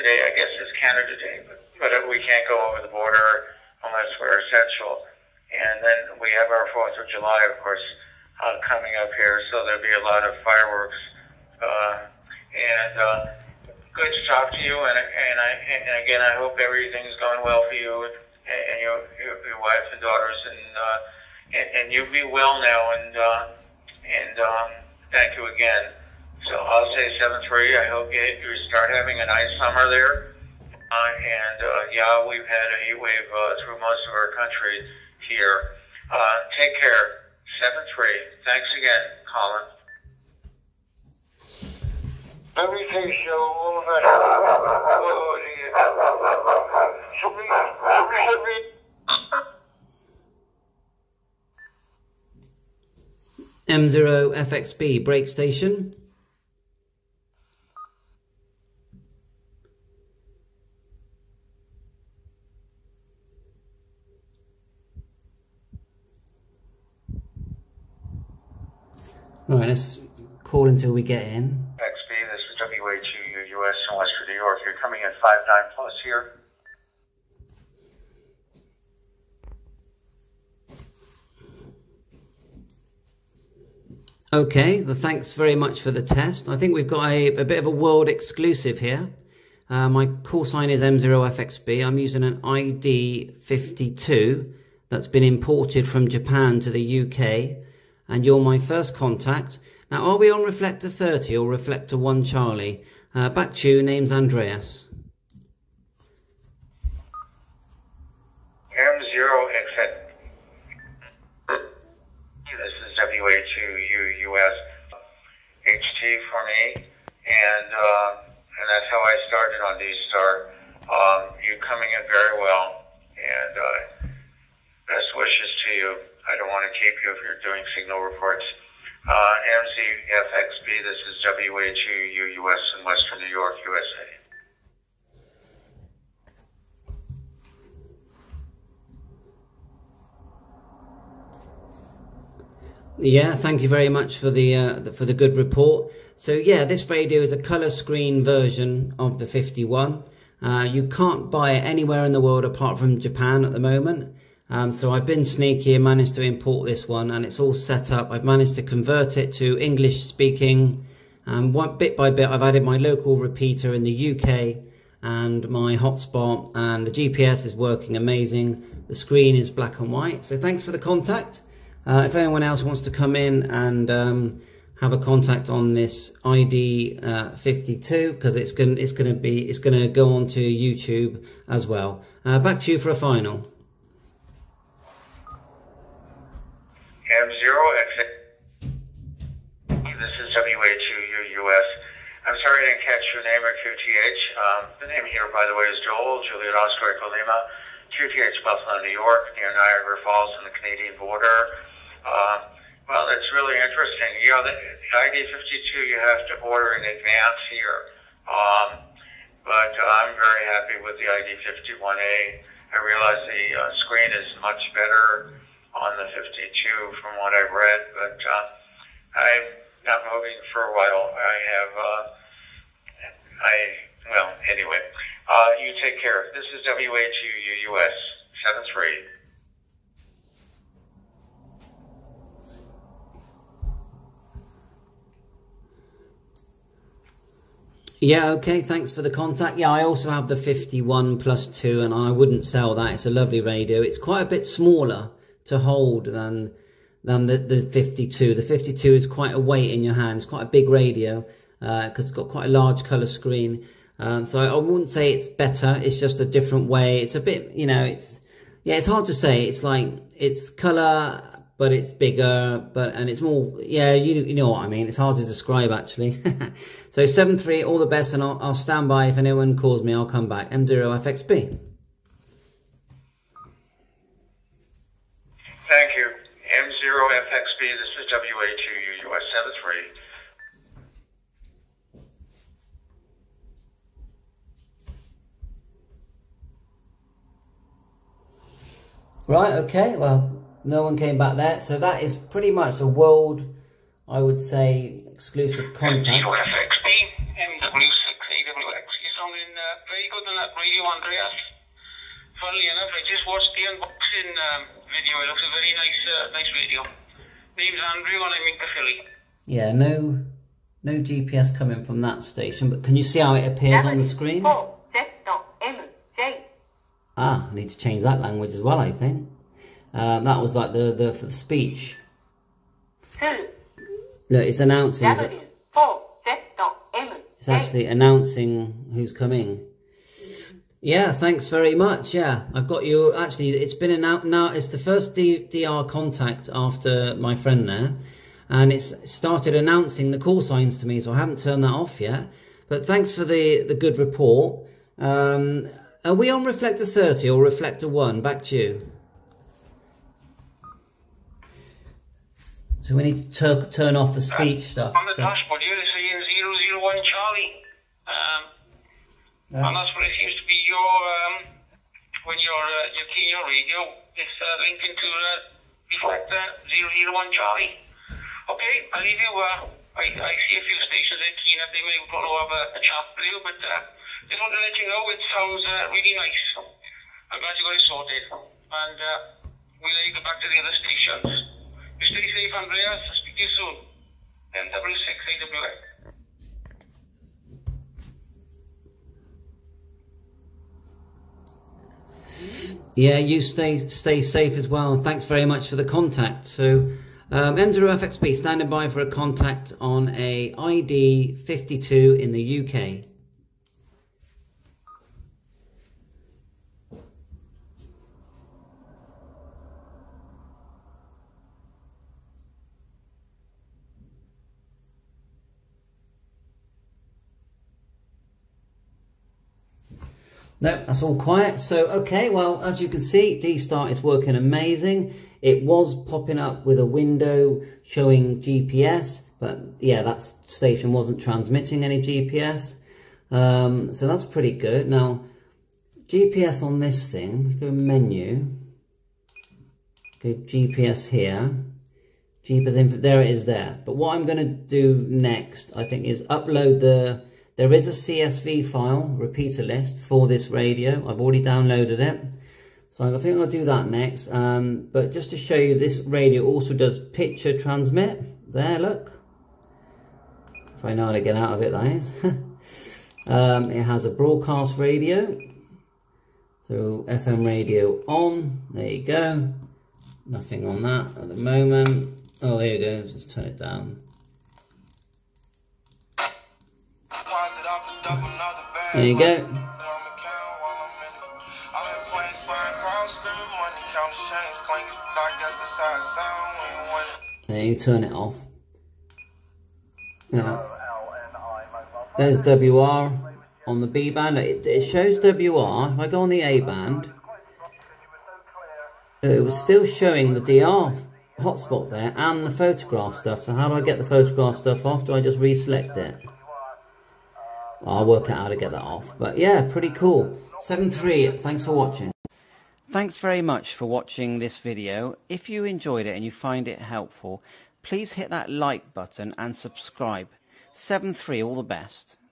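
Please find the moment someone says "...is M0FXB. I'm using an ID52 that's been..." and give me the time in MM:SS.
01:30.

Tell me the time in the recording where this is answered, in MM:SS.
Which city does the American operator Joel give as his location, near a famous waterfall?
03:18.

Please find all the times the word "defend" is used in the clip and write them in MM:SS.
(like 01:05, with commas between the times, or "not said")
not said.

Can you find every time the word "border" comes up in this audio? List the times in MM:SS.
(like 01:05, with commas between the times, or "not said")
00:02, 03:20.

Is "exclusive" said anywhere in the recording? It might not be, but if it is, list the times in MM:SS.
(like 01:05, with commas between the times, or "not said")
01:28, 04:55.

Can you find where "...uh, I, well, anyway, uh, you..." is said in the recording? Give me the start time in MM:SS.
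03:41.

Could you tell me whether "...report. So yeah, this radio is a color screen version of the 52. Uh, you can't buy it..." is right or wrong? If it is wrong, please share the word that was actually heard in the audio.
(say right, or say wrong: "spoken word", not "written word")
wrong: "51", not "52".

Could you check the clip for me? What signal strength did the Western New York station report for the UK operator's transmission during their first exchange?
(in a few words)
59 plus.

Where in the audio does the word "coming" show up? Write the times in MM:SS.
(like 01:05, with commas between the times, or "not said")
00:08, 01:14, 02:01, 05:11, 05:29.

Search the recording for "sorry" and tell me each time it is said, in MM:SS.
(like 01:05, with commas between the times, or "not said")
03:12.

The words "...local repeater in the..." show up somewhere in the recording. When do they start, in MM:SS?
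02:42.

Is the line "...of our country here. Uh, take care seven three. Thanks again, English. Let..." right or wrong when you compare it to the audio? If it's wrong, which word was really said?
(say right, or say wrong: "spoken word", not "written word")
wrong: "Colin", not "English".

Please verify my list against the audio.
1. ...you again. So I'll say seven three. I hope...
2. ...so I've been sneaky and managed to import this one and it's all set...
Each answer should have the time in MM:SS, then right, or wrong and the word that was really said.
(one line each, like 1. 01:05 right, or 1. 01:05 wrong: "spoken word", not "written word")
1. 00:25 right
2. 02:34 right.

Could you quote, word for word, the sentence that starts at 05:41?
So I haven't turned that off yet.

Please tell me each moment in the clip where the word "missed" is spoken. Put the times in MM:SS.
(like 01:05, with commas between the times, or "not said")
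not said.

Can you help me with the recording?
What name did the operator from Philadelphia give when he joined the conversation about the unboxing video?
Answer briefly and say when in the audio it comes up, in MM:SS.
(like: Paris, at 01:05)
Andrew, at 05:07.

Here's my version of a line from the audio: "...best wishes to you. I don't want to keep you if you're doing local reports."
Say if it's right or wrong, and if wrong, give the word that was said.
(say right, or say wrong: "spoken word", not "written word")
wrong: "signal", not "local".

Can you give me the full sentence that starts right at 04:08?
The 52 is quite a weight in your hands, quite a big radio because uh, it's got quite a large colour screen.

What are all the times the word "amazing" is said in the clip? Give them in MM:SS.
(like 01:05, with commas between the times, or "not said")
02:47, 07:04.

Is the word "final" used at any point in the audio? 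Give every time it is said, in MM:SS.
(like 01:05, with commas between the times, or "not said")
03:02.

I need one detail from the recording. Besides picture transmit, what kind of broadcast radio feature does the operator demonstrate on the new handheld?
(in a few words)
FM radio.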